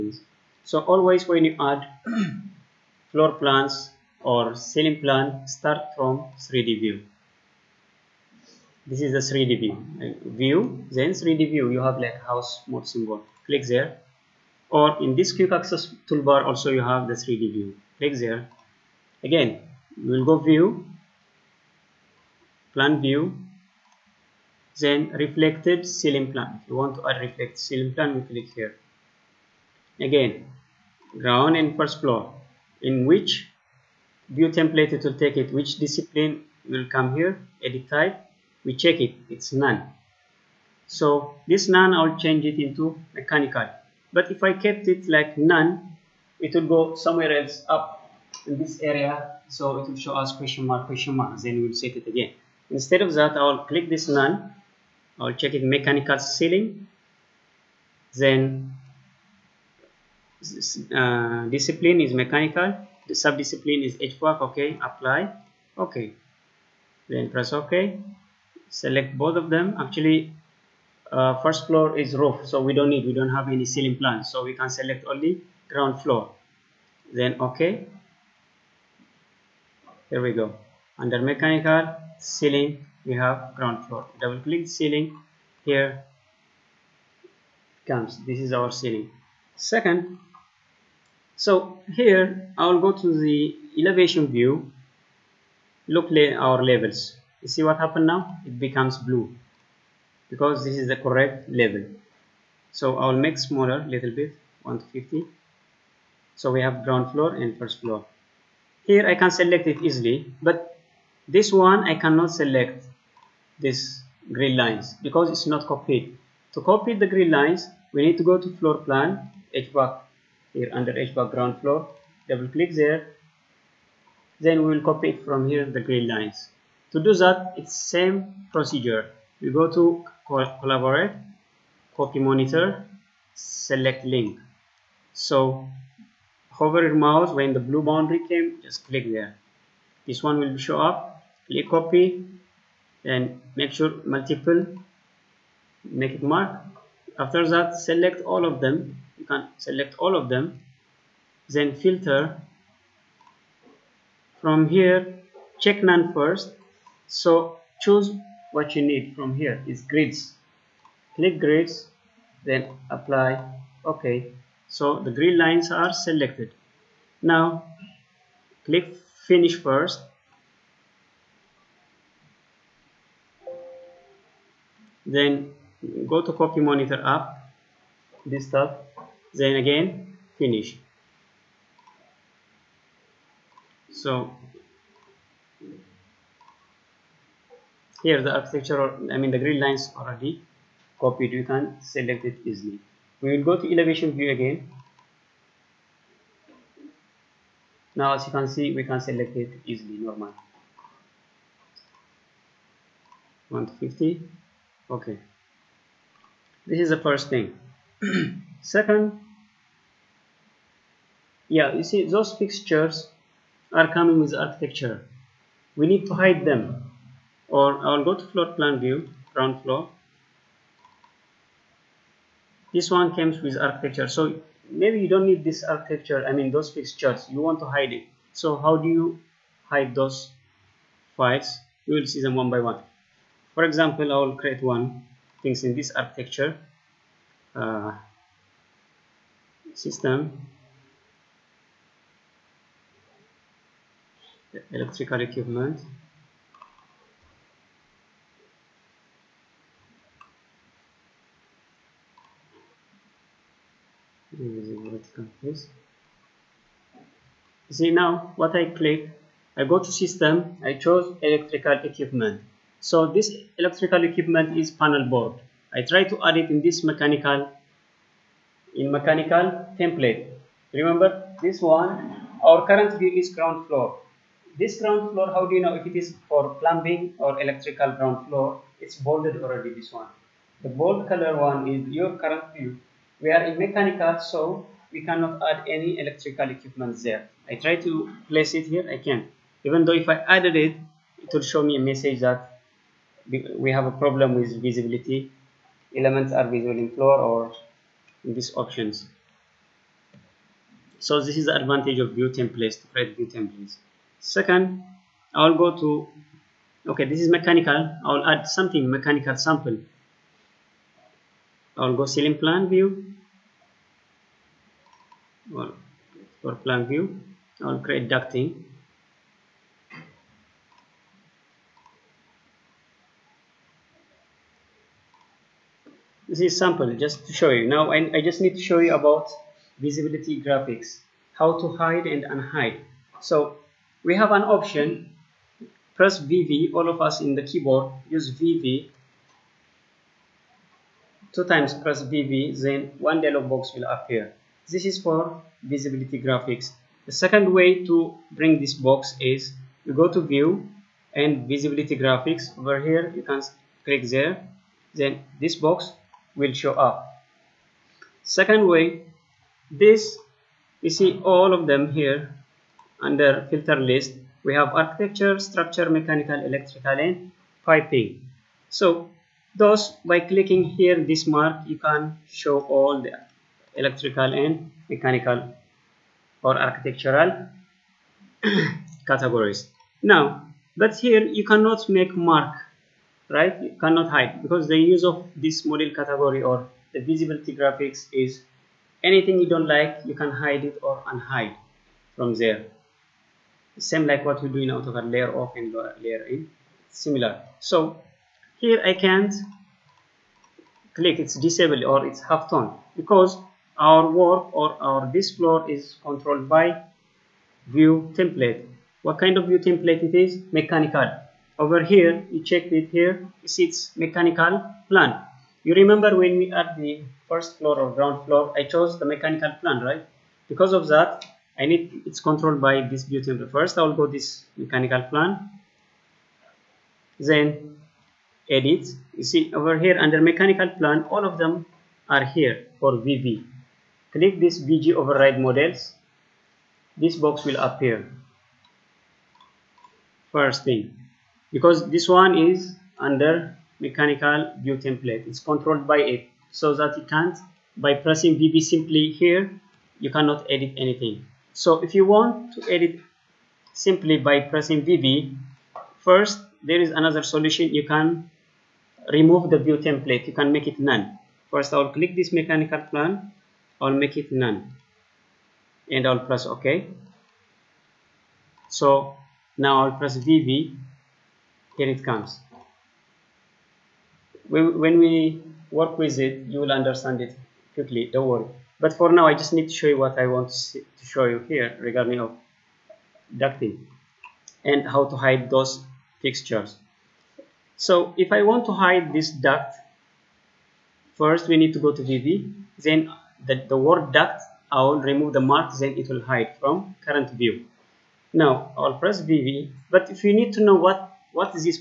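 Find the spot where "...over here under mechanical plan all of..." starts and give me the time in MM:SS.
07:09.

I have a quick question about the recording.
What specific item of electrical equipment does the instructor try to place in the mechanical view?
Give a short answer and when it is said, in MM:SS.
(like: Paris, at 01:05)
Panel board, at 04:24.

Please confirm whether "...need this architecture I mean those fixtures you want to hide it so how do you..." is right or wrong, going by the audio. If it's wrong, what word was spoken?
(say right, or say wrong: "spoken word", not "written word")
right.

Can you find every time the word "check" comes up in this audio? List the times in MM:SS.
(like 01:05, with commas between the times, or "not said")
00:38, 00:55, 02:35, 06:52.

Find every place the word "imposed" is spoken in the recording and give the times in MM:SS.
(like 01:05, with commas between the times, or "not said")
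not said.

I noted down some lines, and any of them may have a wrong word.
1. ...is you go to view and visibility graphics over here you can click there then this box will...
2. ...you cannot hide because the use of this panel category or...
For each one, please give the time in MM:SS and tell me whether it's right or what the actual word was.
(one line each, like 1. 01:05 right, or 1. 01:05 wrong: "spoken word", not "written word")
1. 05:49 right
2. 06:23 wrong: "model", not "panel".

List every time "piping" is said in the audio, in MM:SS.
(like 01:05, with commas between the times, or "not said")
06:07.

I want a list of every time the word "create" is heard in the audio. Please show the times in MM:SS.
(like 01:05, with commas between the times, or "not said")
03:54, 05:02, 05:17.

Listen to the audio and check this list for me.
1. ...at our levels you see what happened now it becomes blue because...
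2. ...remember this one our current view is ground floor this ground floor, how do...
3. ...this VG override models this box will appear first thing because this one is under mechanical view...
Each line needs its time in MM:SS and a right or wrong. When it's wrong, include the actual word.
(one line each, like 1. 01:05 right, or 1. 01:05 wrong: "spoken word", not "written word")
1. 01:36 right
2. 04:30 right
3. 07:14 right.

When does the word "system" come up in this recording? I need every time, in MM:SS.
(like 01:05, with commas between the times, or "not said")
03:59, 04:19.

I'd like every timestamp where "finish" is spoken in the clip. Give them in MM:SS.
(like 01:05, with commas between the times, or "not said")
02:49, 03:00.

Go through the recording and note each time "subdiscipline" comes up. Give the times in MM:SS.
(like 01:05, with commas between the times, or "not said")
01:03.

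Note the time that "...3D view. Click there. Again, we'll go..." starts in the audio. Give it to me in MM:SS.
00:17.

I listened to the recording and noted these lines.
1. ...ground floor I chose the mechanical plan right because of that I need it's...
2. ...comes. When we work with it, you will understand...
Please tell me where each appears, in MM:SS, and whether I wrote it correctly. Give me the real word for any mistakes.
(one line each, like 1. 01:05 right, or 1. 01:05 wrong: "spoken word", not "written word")
1. 06:57 right
2. 07:52 right.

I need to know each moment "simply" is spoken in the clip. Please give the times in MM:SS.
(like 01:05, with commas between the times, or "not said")
07:28, 07:33.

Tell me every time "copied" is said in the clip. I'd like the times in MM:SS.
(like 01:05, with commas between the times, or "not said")
01:55, 03:10.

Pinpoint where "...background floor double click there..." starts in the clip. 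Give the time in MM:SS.
02:01.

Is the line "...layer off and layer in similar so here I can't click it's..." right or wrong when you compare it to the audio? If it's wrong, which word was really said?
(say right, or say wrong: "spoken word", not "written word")
right.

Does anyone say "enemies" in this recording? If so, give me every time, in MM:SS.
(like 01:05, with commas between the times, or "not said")
not said.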